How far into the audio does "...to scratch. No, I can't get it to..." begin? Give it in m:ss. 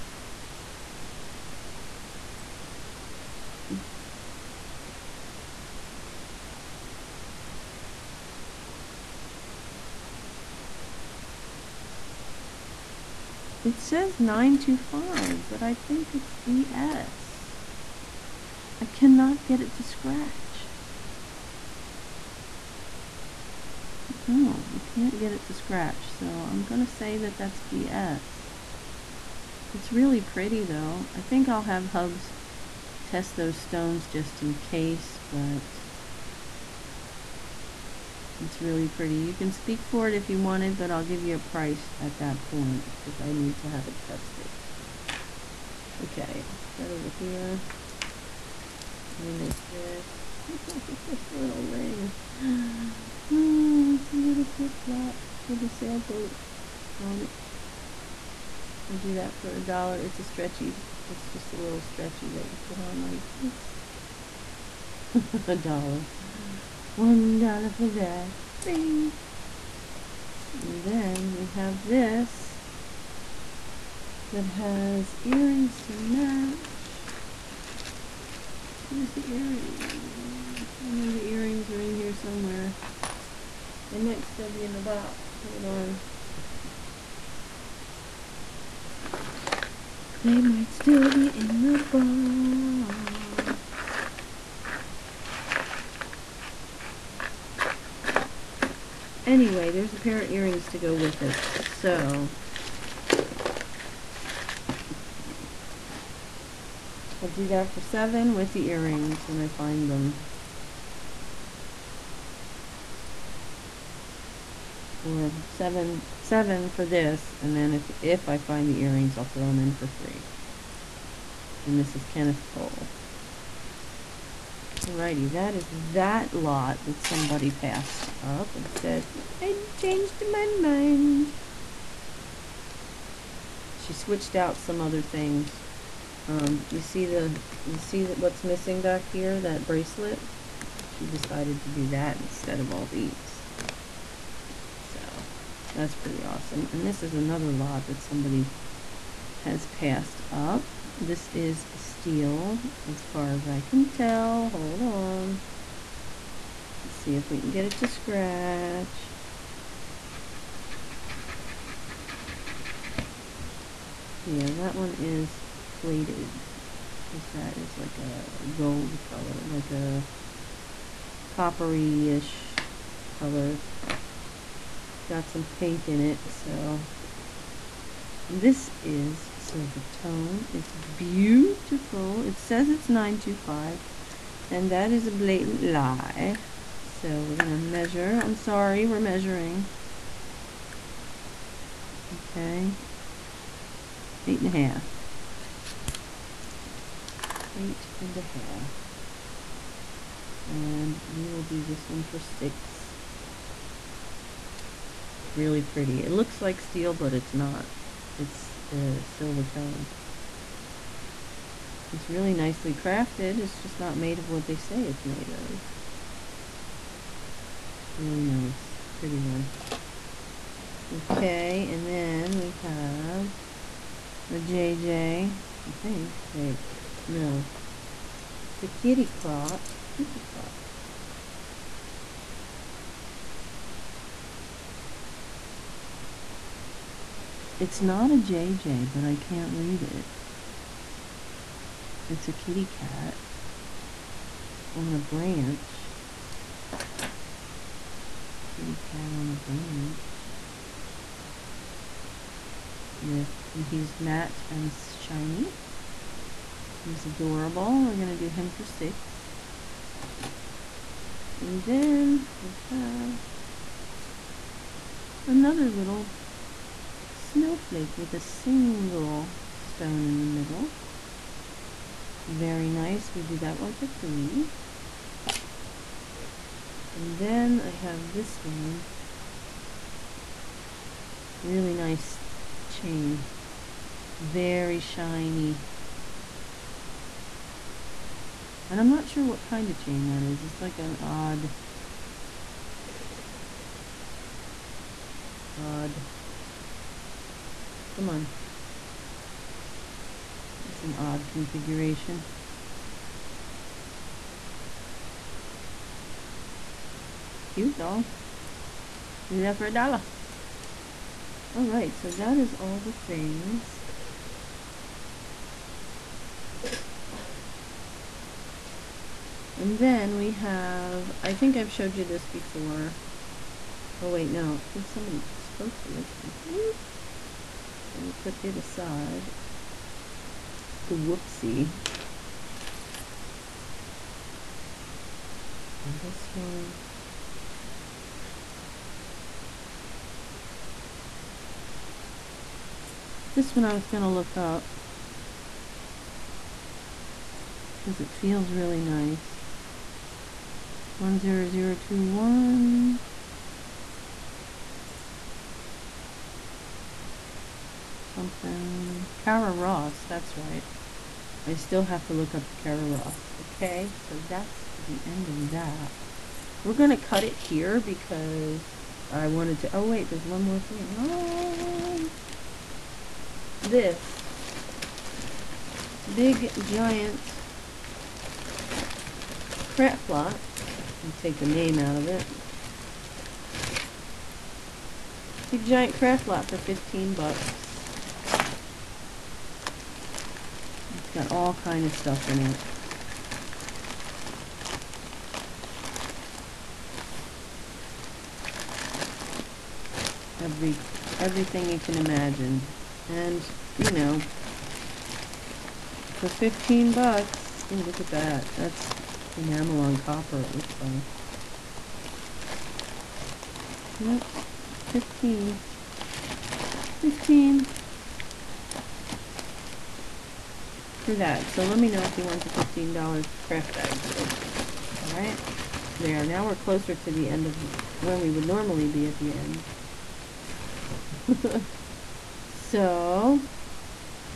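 0:19.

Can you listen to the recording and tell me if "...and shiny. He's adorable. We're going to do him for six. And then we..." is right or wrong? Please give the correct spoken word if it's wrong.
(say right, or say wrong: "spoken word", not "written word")
right.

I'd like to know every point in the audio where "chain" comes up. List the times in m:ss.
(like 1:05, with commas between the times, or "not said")
4:42, 4:49.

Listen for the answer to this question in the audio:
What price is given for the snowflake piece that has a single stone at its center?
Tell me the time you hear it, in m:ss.
4:33.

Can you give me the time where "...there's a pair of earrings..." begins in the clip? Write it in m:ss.
1:39.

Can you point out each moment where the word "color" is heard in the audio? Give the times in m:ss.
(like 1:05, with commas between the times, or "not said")
2:49, 2:53.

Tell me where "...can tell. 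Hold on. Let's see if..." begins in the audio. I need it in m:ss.
2:33.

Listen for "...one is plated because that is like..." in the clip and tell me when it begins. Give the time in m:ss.
2:44.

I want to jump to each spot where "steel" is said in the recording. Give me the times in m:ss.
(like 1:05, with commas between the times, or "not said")
2:31, 3:26.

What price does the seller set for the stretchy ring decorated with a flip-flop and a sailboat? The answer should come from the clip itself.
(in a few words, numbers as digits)
$1.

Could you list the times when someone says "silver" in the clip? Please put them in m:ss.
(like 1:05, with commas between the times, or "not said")
2:59, 3:29.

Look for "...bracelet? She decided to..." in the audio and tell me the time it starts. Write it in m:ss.
2:19.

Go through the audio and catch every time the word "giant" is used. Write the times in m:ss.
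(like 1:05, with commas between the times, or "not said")
6:16, 6:25.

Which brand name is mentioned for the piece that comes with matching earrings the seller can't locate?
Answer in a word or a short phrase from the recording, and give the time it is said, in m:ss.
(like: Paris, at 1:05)
Kenneth Cole, at 2:02.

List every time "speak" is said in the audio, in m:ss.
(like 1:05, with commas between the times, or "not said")
0:39.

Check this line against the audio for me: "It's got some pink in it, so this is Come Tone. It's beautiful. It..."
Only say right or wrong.
wrong.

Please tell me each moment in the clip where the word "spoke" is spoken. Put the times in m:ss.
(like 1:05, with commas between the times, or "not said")
5:25.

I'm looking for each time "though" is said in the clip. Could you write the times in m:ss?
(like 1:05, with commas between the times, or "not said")
0:30, 5:07.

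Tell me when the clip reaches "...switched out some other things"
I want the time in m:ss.
2:13.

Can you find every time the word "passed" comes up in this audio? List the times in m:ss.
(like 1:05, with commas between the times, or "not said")
2:07, 2:29.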